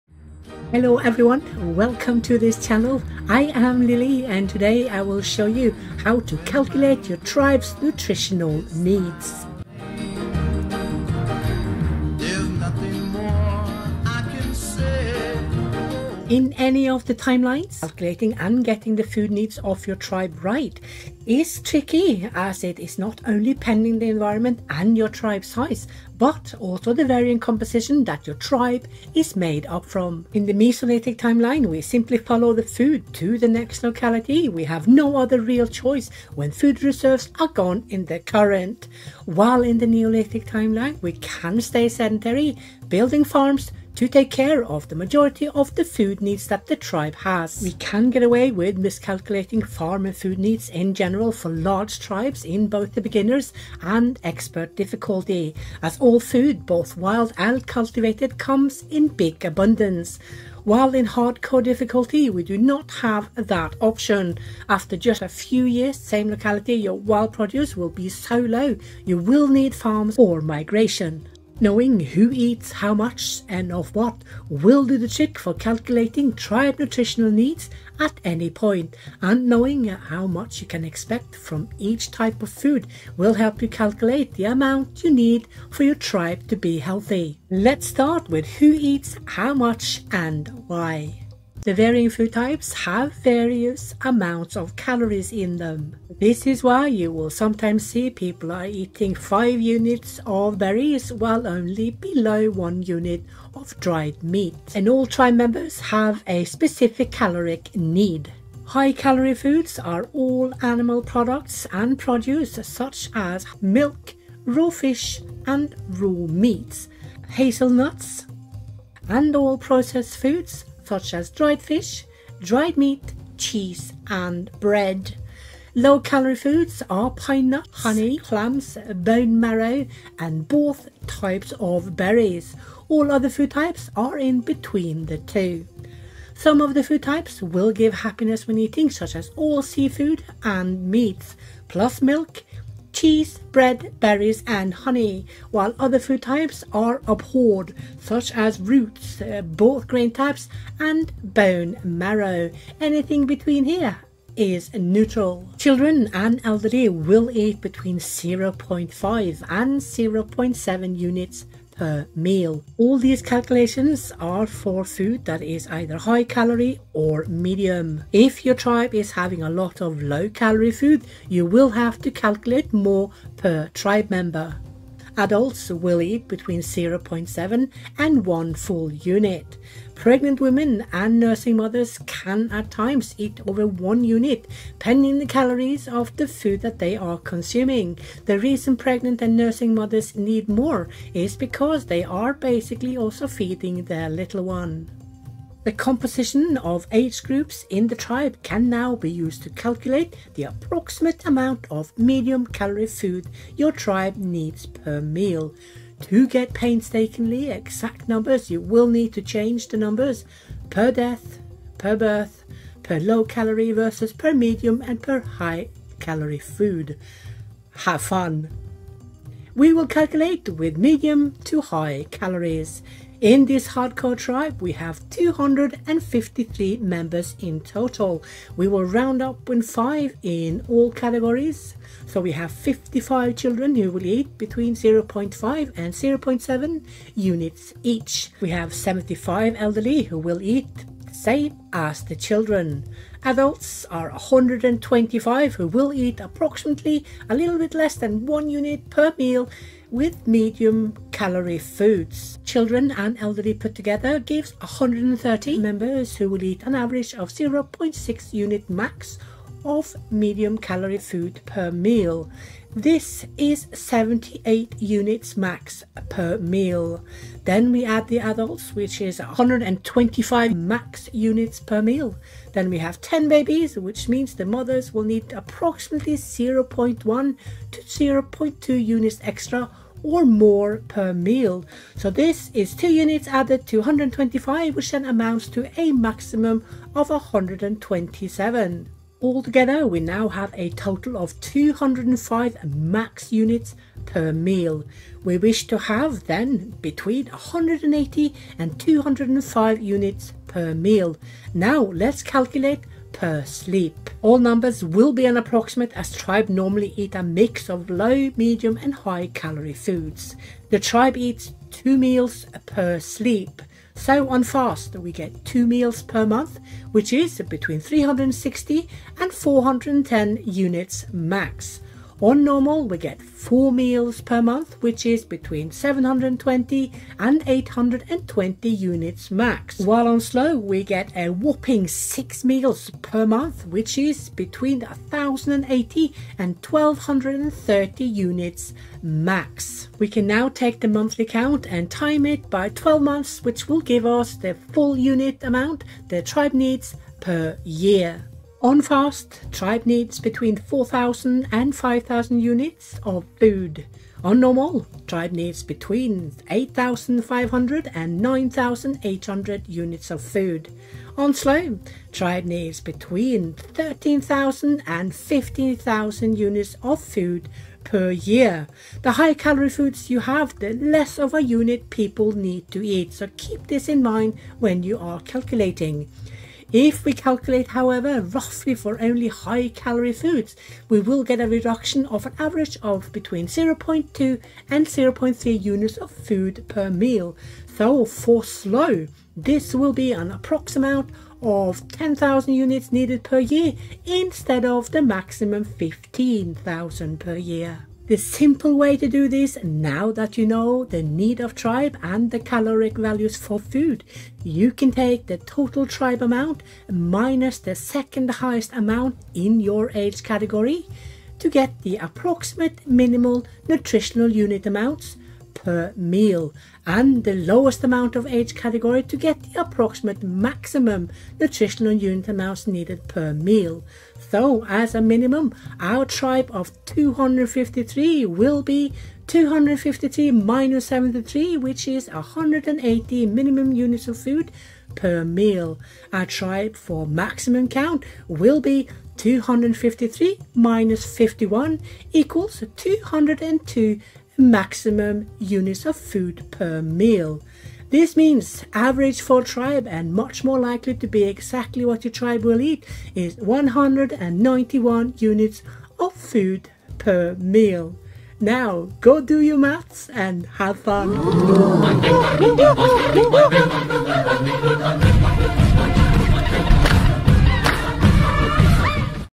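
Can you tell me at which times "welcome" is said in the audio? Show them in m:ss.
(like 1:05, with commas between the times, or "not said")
0:01.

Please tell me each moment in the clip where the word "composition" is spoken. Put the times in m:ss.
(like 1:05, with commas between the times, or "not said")
0:27, 3:15.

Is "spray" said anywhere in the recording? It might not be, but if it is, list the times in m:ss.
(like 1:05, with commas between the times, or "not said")
not said.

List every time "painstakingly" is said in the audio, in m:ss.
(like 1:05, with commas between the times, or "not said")
3:26.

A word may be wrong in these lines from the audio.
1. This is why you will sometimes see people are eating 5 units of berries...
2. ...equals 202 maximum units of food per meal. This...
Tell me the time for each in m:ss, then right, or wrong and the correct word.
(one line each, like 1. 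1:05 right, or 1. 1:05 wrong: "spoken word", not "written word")
1. 1:36 right
2. 7:22 right.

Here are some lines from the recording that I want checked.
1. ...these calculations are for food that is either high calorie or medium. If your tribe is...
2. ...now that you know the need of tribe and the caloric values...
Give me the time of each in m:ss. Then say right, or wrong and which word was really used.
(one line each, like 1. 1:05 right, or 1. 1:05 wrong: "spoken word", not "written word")
1. 2:42 right
2. 6:39 right.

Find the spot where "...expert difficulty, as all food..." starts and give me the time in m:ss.
0:54.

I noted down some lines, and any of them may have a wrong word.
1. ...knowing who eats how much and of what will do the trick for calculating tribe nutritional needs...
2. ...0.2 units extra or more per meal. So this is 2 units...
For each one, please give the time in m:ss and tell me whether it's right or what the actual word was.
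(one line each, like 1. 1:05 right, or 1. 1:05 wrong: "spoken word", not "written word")
1. 1:11 right
2. 4:37 right.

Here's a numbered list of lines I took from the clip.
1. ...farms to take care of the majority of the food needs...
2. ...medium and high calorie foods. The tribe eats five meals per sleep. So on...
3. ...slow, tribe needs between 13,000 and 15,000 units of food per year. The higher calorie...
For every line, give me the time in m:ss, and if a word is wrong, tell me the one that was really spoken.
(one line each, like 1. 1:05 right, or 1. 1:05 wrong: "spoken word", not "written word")
1. 0:43 right
2. 5:08 wrong: "two", not "five"
3. 6:01 right.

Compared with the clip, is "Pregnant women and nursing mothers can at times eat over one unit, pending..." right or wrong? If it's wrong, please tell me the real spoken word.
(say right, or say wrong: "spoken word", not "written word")
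right.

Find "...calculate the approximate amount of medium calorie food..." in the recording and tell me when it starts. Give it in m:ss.
3:19.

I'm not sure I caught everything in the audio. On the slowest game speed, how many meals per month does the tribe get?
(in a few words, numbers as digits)
6.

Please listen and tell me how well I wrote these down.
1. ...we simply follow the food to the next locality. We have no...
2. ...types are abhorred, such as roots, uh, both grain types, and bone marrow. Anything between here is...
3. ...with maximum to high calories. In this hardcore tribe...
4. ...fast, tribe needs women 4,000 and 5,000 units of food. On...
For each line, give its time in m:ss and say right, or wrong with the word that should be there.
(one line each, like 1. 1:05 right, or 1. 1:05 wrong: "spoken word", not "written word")
1. 0:31 right
2. 2:26 right
3. 3:40 wrong: "medium", not "maximum"
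4. 5:48 wrong: "between", not "women".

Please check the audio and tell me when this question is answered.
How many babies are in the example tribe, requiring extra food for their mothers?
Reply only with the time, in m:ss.
4:33.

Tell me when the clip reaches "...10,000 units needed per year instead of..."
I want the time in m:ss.
6:31.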